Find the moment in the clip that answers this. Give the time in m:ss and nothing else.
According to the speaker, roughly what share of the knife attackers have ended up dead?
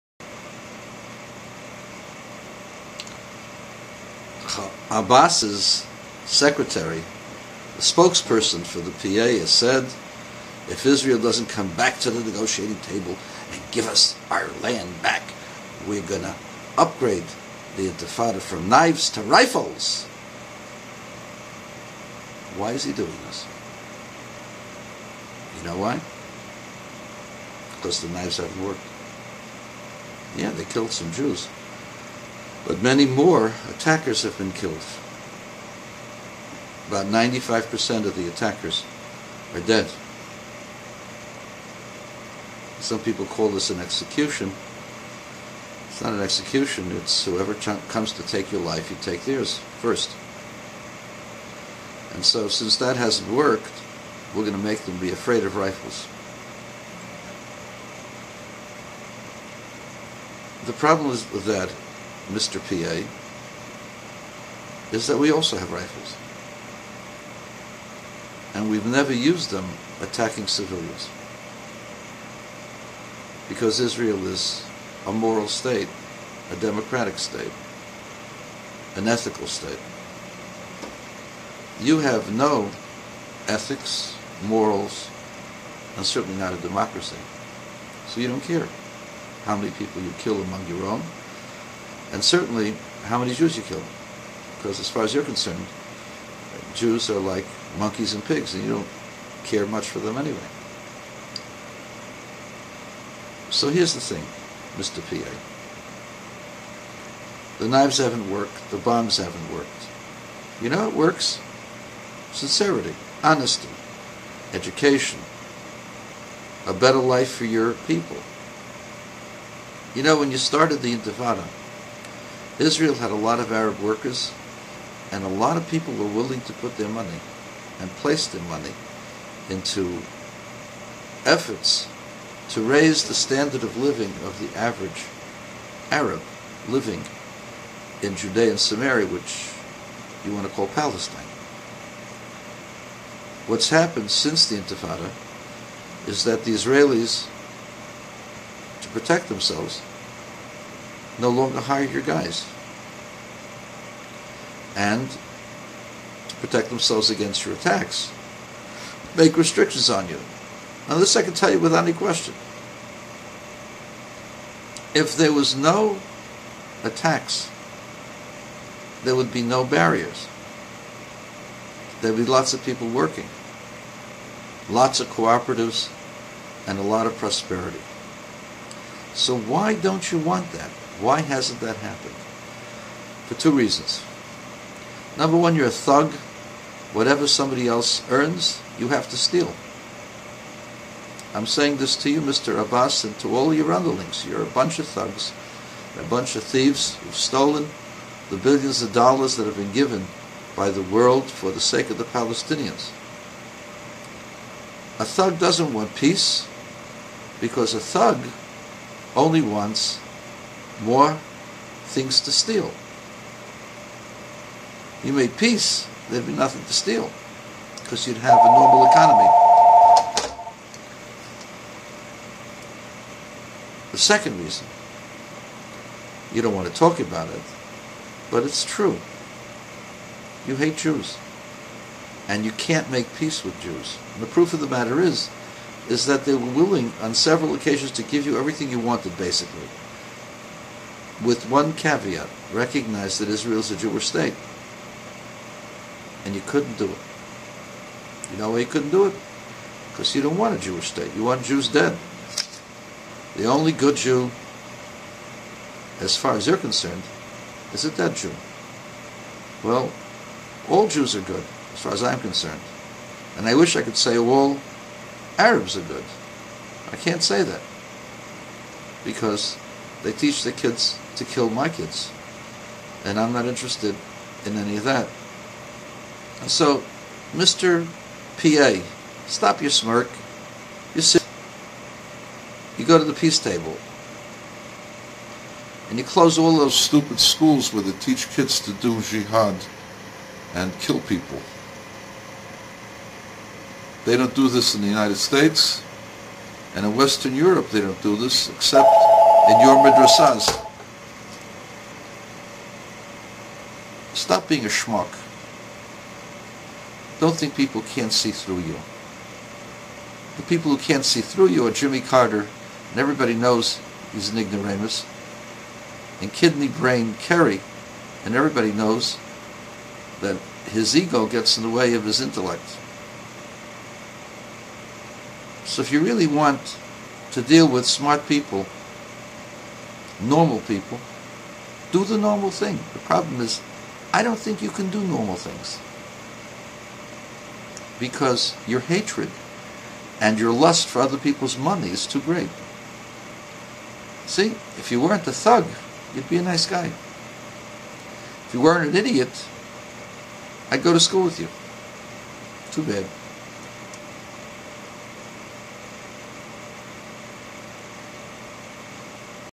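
0:37.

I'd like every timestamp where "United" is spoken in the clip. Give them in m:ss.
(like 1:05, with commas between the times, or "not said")
4:54.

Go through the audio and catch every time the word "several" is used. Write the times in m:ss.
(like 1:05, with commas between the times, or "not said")
3:57.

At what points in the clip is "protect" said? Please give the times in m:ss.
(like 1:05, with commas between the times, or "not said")
2:28, 2:36.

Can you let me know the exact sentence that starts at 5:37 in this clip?
Because your hatred and your lust for other people's money is too great.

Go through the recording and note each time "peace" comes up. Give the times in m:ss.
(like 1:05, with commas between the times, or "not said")
3:25, 3:35, 3:53, 4:43.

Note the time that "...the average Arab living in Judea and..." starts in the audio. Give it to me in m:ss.
2:14.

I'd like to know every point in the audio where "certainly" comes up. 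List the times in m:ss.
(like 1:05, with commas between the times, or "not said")
1:26, 1:32.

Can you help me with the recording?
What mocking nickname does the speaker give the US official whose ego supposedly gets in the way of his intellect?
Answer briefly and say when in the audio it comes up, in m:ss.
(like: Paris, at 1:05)
Kidney Brain Kerry, at 5:16.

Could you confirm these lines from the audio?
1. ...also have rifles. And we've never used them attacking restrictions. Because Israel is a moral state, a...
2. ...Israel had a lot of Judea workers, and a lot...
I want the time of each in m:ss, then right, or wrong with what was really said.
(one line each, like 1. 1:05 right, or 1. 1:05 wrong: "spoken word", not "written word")
1. 1:05 wrong: "civilians", not "restrictions"
2. 2:02 wrong: "Arab", not "Judea".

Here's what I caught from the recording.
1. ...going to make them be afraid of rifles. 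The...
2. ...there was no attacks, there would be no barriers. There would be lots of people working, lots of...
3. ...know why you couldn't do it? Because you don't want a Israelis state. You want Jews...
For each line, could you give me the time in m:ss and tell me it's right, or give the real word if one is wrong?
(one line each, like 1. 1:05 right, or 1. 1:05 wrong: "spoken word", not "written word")
1. 0:54 right
2. 2:45 right
3. 4:08 wrong: "Jewish", not "Israelis".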